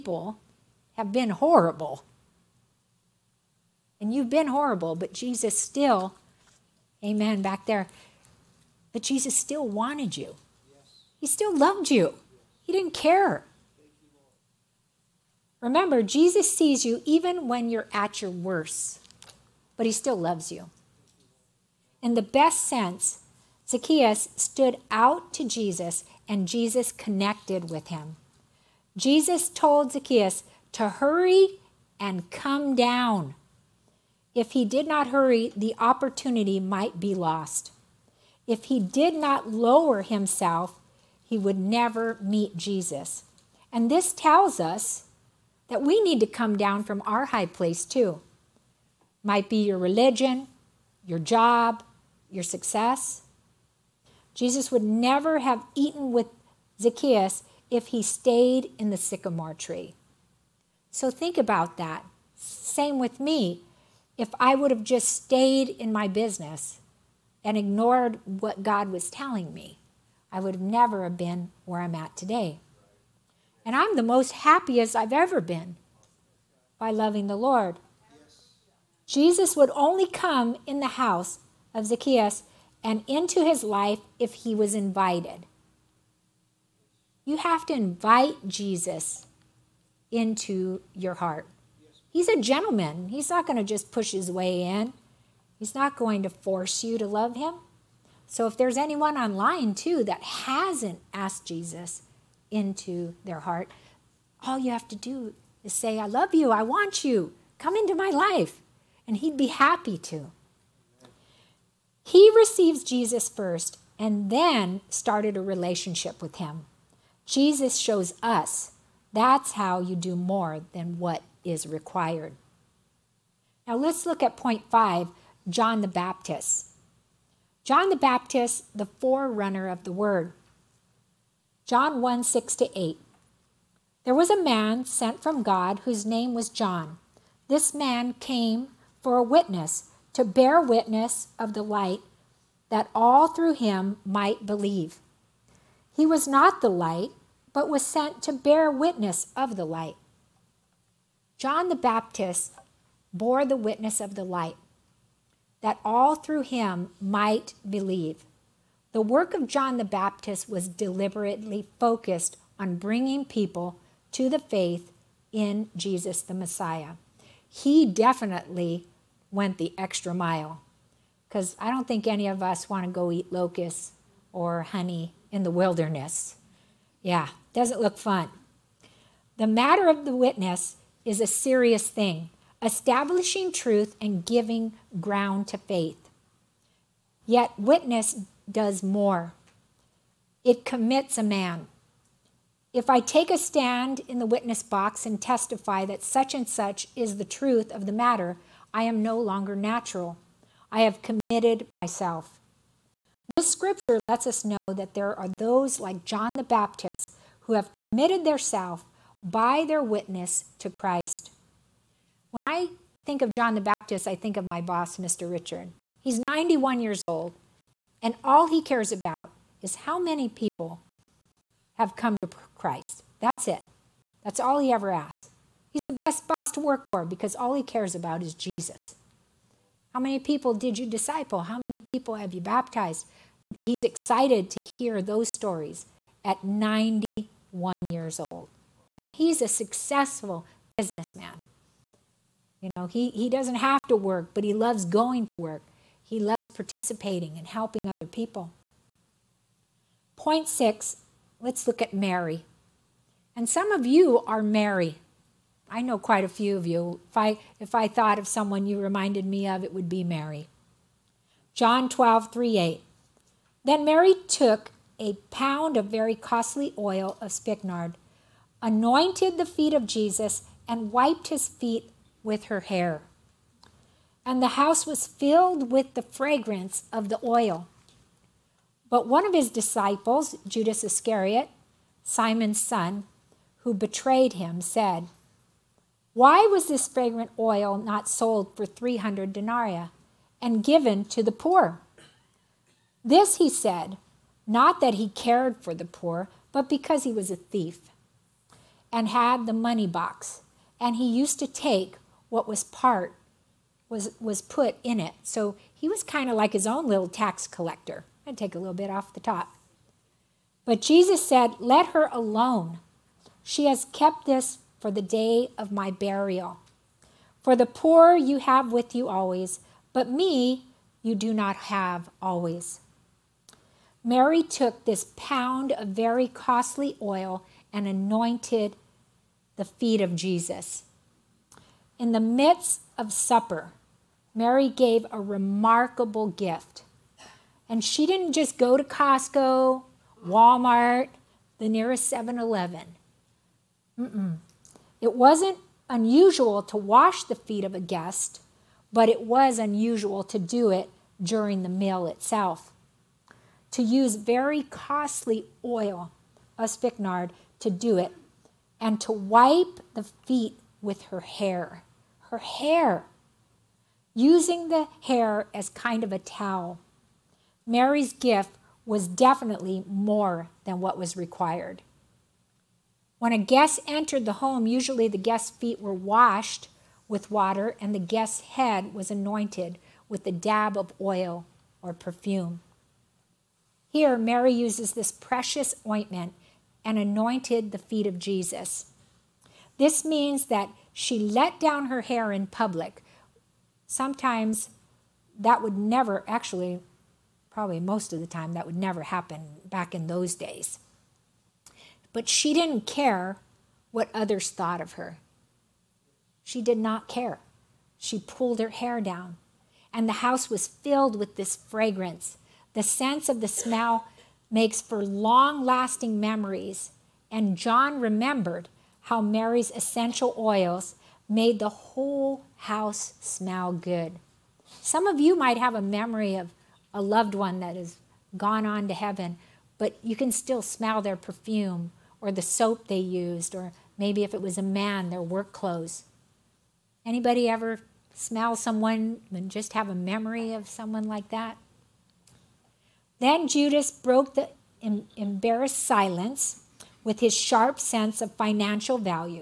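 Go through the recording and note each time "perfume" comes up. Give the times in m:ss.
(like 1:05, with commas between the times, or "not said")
6:21, 7:11.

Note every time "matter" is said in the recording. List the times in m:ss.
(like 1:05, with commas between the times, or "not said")
2:59, 3:17.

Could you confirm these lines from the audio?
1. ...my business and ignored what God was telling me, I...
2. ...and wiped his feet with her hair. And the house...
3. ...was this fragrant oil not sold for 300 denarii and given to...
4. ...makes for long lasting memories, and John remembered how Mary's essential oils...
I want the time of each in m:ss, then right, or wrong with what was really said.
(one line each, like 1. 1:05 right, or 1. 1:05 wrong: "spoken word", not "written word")
1. 1:05 right
2. 4:30 right
3. 4:46 right
4. 6:54 right.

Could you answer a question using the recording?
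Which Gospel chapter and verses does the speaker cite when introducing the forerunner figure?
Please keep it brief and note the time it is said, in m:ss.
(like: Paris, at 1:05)
John 1:6-8, at 2:11.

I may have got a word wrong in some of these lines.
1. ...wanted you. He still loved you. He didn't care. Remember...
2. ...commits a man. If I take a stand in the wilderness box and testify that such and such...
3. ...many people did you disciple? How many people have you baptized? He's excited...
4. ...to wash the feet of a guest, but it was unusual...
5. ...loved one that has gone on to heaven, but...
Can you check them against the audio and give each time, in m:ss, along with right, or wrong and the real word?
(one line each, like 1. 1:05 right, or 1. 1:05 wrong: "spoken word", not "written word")
1. 0:09 right
2. 3:10 wrong: "witness", not "wilderness"
3. 3:49 right
4. 5:46 right
5. 7:07 right.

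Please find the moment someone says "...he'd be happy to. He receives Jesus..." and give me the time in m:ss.
1:49.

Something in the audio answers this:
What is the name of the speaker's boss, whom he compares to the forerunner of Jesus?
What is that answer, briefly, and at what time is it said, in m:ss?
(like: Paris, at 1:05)
Mr. Richard, at 3:34.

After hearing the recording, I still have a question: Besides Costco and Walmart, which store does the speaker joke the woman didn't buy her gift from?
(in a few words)
7-Eleven.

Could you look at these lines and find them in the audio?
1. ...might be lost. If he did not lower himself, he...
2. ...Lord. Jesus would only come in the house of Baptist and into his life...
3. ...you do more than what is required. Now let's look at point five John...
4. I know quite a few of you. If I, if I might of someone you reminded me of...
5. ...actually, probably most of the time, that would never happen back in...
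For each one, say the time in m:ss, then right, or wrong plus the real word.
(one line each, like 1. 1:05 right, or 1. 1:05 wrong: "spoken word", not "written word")
1. 0:36 right
2. 1:17 wrong: "Zacchaeus", not "Baptist"
3. 1:59 right
4. 4:15 wrong: "thought", not "might"
5. 6:36 right.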